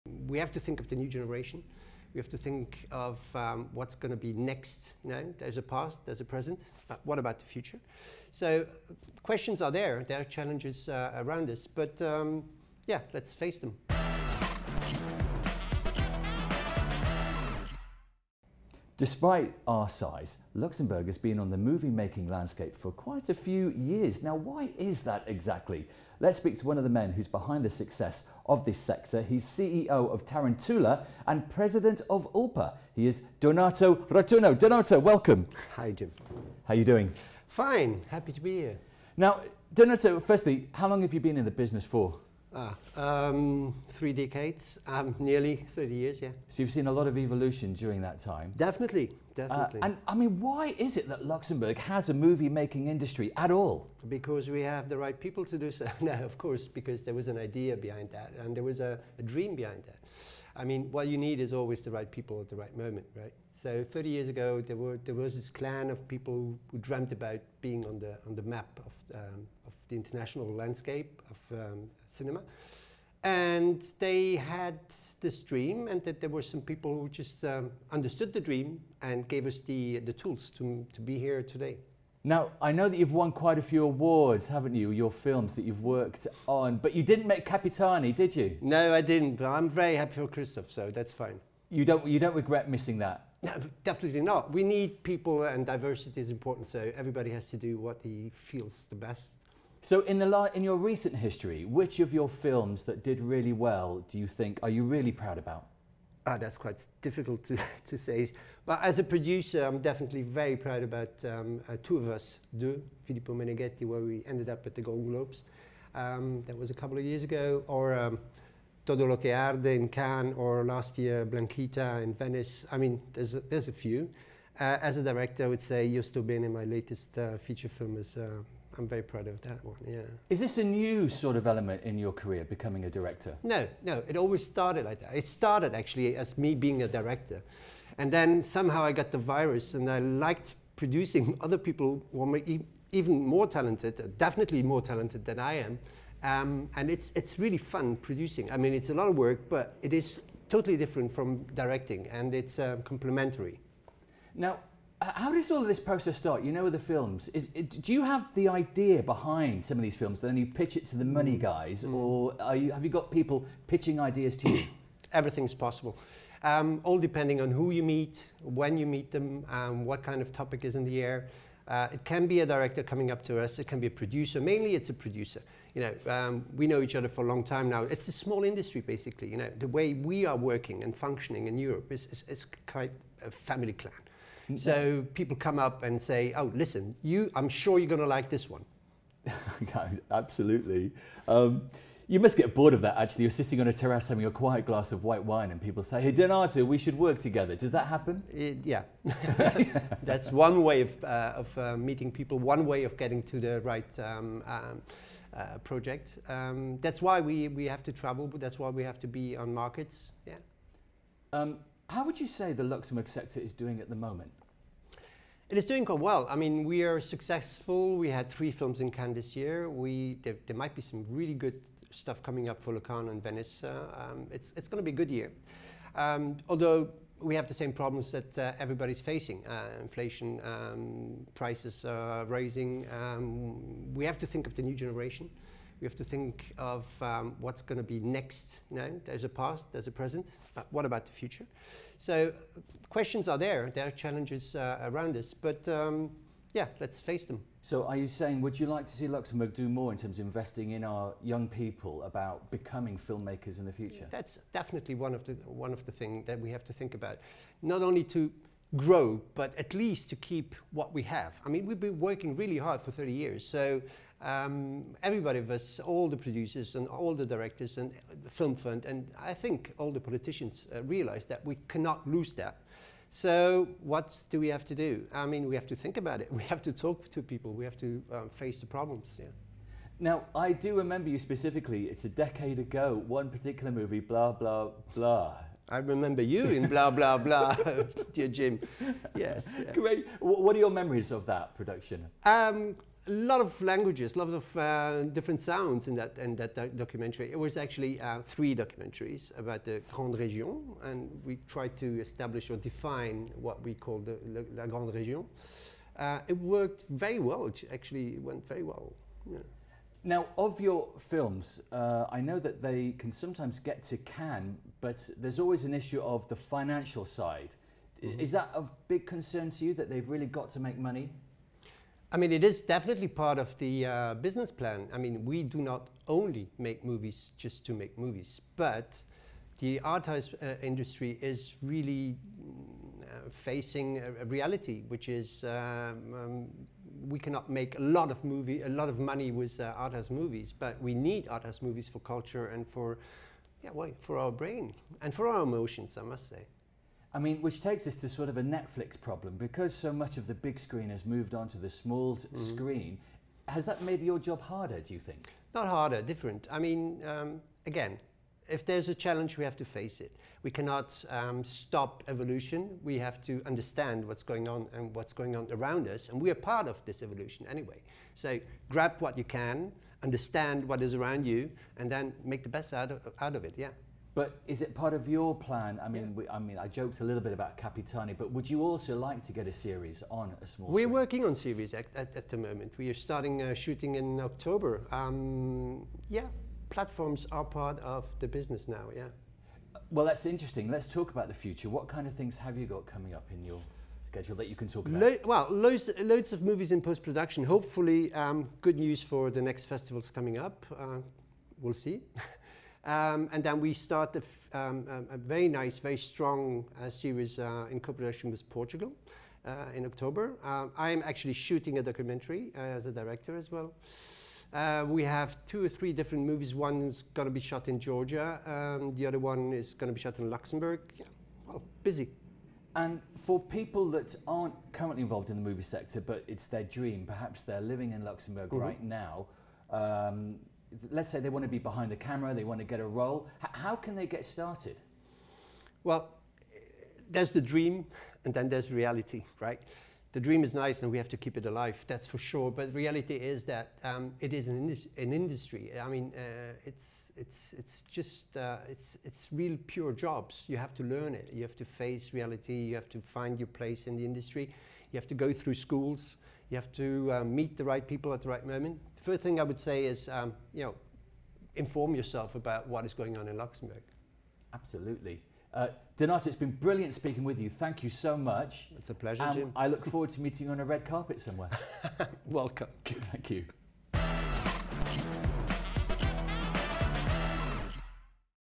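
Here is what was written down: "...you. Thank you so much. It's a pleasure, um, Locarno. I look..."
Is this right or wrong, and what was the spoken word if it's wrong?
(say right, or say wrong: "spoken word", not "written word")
wrong: "Jim", not "Locarno".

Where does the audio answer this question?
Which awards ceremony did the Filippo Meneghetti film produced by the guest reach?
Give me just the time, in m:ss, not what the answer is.
1:54.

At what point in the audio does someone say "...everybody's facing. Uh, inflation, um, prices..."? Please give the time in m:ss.
3:48.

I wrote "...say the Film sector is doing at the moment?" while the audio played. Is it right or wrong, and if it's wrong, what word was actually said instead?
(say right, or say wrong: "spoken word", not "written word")
wrong: "Luxembourg", not "Film".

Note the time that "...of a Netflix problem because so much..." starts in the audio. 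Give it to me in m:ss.
5:48.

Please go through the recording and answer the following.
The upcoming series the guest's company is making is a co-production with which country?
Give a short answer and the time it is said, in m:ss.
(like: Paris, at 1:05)
Portugal, at 6:48.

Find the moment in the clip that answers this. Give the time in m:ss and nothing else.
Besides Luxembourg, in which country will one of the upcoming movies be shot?
6:57.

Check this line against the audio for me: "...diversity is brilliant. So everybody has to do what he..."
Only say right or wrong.
wrong.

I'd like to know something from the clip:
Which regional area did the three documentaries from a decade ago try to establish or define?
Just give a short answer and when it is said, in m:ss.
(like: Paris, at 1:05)
La Grande Région, at 5:04.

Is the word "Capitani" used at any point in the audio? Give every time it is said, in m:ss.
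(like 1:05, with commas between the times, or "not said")
1:27, 6:17.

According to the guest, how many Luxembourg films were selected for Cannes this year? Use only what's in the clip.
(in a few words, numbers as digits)
3.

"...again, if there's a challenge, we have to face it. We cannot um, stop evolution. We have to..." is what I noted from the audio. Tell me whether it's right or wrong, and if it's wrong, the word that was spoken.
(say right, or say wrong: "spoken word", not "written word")
right.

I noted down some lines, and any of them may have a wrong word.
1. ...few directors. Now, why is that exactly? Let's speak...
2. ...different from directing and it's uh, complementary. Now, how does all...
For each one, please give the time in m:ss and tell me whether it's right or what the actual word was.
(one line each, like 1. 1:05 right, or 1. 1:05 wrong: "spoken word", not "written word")
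1. 0:23 wrong: "years", not "directors"
2. 2:30 right.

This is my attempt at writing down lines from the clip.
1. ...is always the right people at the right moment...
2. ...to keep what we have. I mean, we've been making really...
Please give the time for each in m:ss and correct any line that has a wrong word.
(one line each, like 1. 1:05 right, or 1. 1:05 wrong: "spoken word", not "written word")
1. 1:01 right
2. 4:20 wrong: "working", not "making".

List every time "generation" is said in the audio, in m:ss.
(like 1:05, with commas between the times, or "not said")
0:01, 3:54.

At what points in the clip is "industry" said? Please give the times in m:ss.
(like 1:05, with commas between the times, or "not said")
0:52, 2:58, 5:30, 7:25, 7:34.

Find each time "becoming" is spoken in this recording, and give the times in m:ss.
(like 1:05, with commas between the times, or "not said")
2:12, 4:12.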